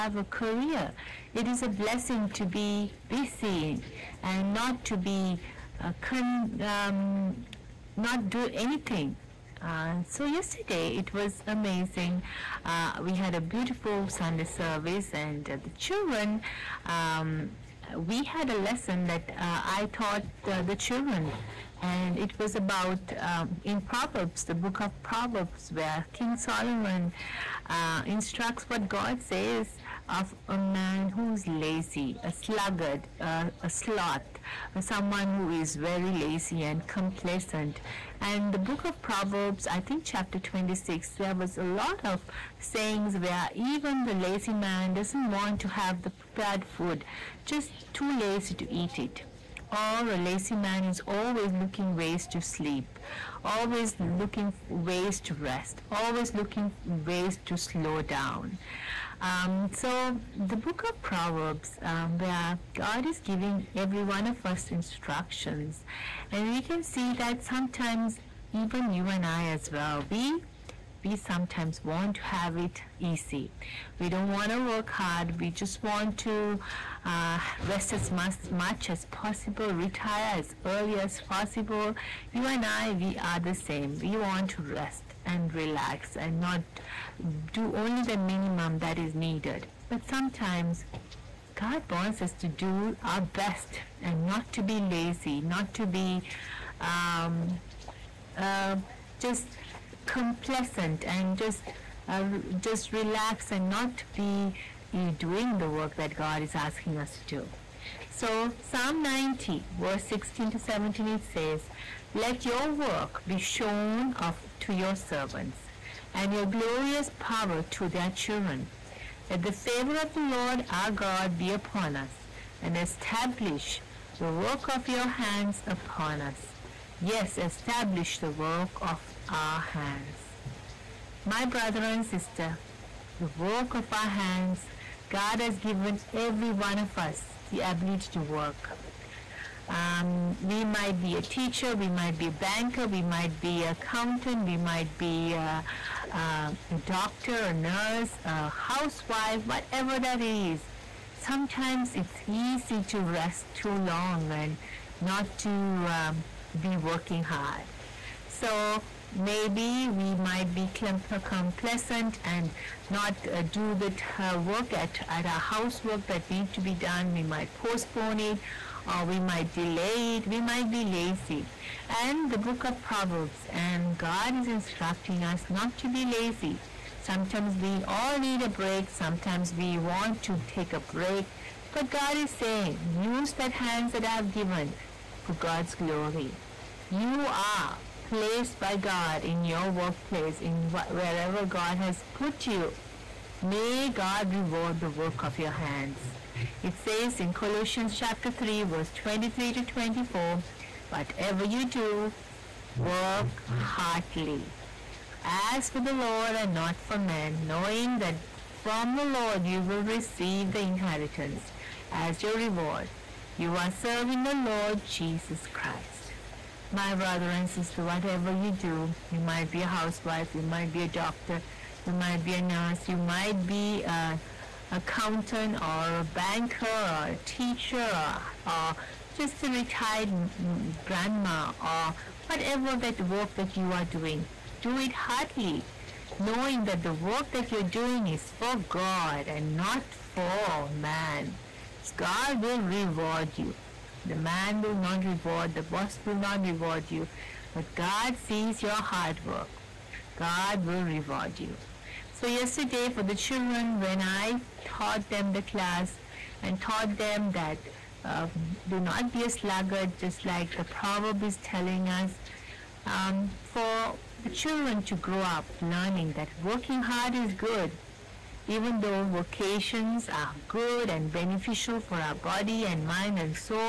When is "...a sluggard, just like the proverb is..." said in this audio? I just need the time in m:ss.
4:19.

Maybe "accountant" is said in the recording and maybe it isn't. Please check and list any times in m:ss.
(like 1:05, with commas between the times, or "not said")
2:23, 3:44.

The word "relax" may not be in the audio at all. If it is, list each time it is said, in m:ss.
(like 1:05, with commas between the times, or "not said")
1:25, 1:42.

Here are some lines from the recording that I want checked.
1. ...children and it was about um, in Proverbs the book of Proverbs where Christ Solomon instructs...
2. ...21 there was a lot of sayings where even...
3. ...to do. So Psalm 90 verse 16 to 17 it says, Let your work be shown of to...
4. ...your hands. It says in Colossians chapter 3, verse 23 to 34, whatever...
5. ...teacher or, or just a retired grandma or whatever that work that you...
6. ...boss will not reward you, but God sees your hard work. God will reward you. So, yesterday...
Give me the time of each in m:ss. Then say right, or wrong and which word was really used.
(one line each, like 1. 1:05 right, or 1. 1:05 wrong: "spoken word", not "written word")
1. 0:20 wrong: "King", not "Christ"
2. 0:40 wrong: "26", not "21"
3. 1:47 right
4. 3:15 wrong: "24", not "34"
5. 3:47 right
6. 4:05 right.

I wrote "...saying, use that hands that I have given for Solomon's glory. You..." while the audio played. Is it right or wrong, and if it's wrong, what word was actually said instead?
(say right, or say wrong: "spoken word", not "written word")
wrong: "God", not "Solomon".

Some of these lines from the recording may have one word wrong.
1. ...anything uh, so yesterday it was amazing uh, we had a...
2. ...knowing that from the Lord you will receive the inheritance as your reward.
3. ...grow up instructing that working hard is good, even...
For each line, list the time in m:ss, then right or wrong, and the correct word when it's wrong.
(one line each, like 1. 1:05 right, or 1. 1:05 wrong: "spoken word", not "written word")
1. 0:08 right
2. 3:27 right
3. 4:25 wrong: "learning", not "instructing".